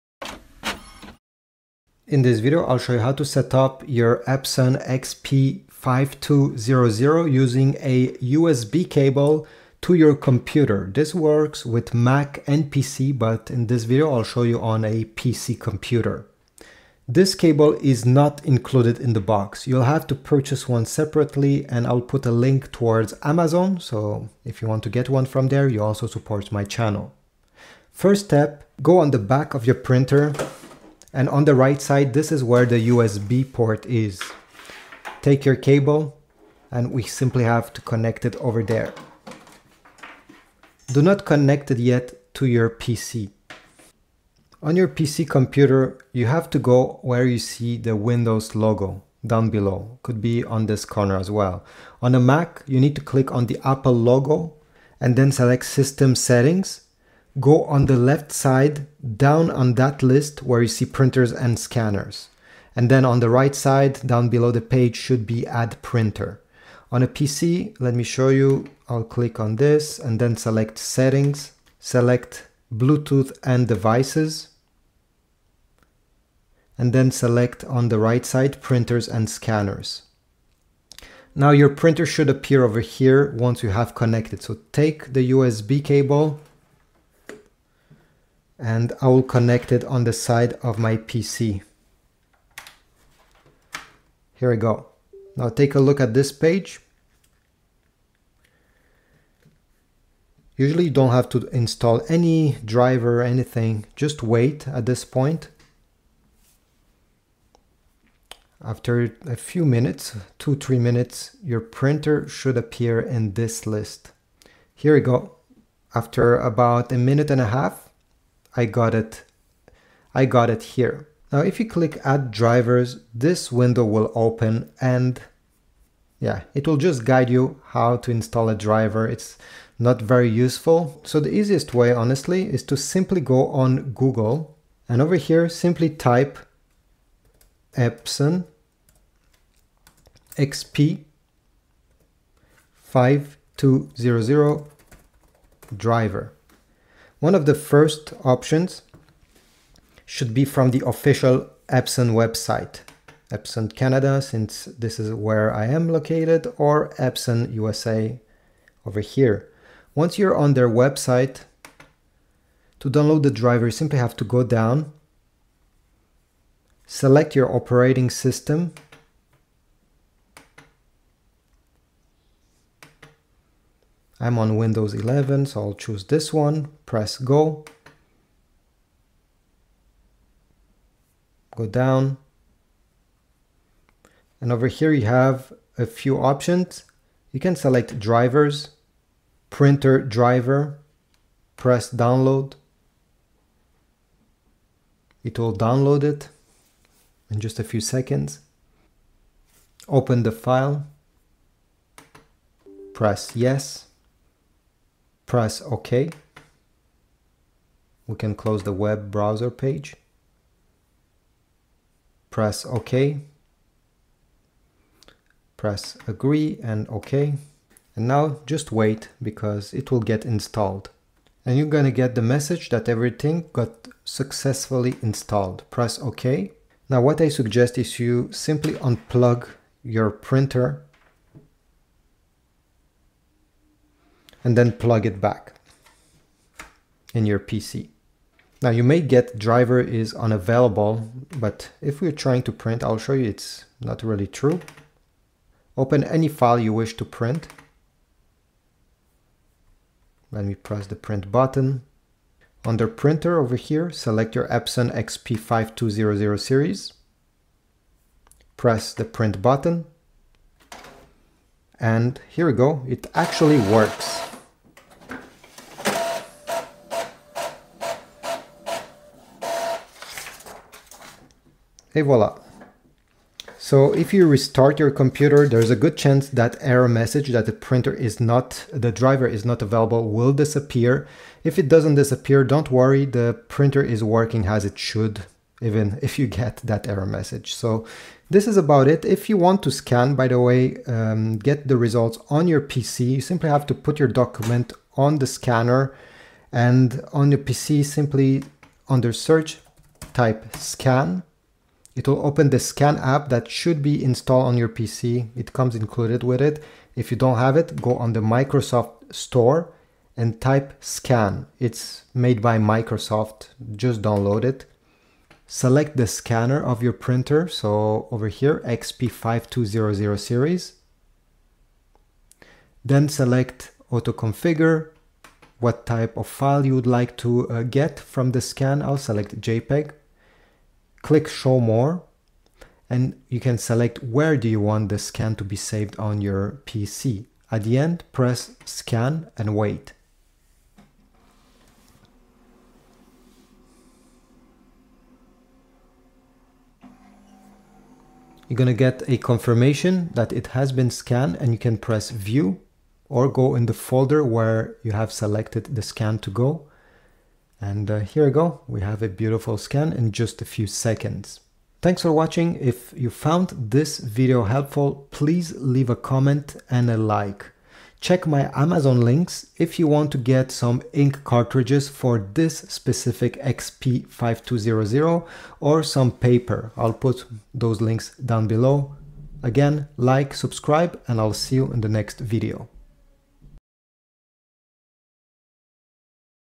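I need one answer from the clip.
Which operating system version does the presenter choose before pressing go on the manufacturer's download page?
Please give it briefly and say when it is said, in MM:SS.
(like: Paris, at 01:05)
Windows 11, at 02:54.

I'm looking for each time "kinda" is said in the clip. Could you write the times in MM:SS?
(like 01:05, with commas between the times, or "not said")
not said.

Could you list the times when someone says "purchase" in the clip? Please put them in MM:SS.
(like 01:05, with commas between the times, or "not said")
00:20.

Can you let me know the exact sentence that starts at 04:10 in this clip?
Let me press the print button.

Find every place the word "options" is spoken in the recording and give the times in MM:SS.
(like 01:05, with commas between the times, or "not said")
02:28, 03:06.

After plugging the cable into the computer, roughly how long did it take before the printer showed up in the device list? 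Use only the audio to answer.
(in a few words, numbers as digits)
about a minute and a half.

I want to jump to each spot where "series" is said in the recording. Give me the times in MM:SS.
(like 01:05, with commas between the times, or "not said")
04:16, 05:20.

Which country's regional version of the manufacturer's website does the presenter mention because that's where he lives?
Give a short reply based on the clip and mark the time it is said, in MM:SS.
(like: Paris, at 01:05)
Canada, at 02:33.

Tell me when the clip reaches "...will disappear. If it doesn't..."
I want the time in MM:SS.
04:40.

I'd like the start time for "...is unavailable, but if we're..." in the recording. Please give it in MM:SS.
03:59.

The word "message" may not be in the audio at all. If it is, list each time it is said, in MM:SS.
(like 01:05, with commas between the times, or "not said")
03:42, 04:36, 04:47.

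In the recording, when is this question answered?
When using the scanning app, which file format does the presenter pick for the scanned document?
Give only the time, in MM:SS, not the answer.
05:29.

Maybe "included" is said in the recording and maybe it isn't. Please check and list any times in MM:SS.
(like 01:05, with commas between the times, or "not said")
00:18, 05:05.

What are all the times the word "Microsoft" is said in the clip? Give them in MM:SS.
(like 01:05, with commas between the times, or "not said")
05:08, 05:12.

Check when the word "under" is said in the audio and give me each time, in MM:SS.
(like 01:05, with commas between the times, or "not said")
04:12, 04:58.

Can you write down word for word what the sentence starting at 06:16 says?
I'll put those links down below.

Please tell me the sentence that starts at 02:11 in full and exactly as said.
So the easiest way, honestly, is to simply go on Google and over here, simply type Epson XP 5200 driver.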